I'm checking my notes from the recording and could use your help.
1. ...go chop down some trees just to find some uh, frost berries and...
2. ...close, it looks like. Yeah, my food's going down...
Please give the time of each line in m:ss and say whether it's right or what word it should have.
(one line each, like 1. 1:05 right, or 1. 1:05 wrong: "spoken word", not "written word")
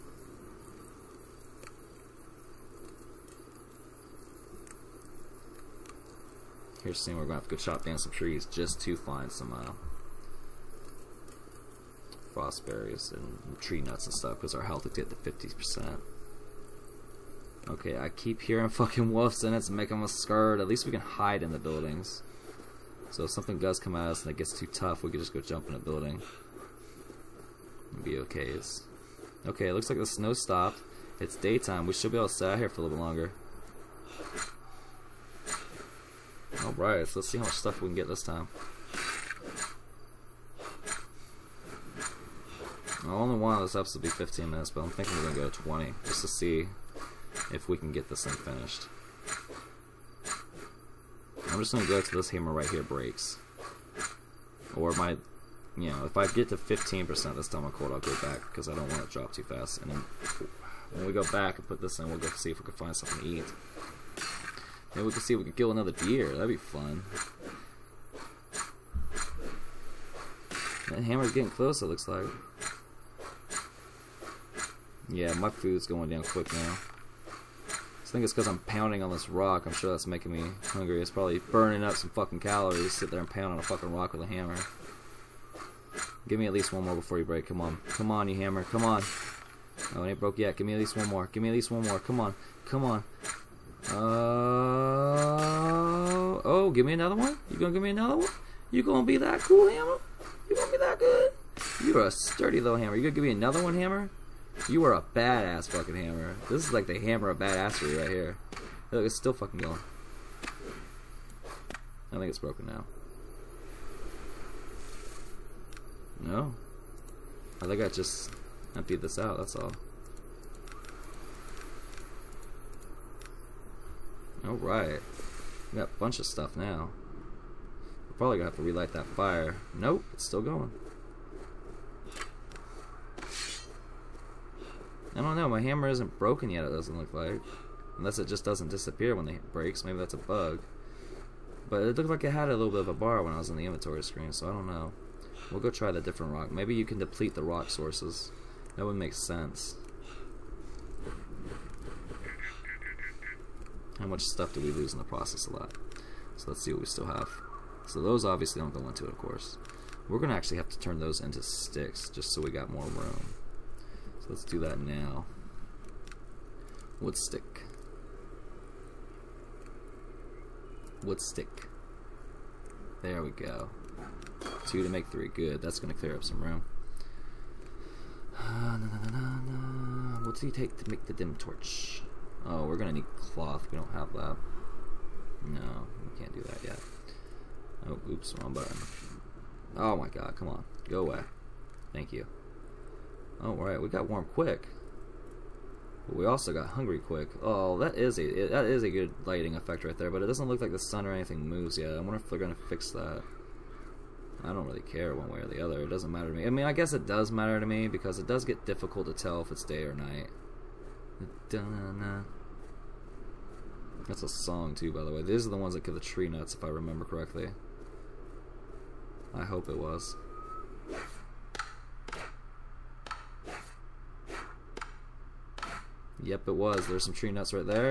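1. 0:07 right
2. 1:11 right.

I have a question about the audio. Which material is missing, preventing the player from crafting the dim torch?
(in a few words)
Cloth.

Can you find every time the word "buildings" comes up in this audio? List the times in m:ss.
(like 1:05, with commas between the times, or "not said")
0:21, 0:25.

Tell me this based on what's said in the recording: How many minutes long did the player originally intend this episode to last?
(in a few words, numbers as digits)
15.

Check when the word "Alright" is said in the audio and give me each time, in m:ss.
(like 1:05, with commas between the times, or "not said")
0:36, 2:04, 3:13.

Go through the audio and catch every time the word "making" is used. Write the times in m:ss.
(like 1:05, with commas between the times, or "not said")
0:19, 1:20.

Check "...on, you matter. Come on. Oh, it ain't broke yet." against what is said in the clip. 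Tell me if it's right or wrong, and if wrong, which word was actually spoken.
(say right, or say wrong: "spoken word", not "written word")
wrong: "hammer", not "matter".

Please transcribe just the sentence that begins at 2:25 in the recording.
We'll go try the different rock.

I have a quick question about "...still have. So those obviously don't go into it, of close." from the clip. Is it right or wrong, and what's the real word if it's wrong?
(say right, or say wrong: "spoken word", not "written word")
wrong: "course", not "close".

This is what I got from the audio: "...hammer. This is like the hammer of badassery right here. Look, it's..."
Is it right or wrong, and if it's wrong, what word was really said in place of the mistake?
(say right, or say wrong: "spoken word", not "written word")
right.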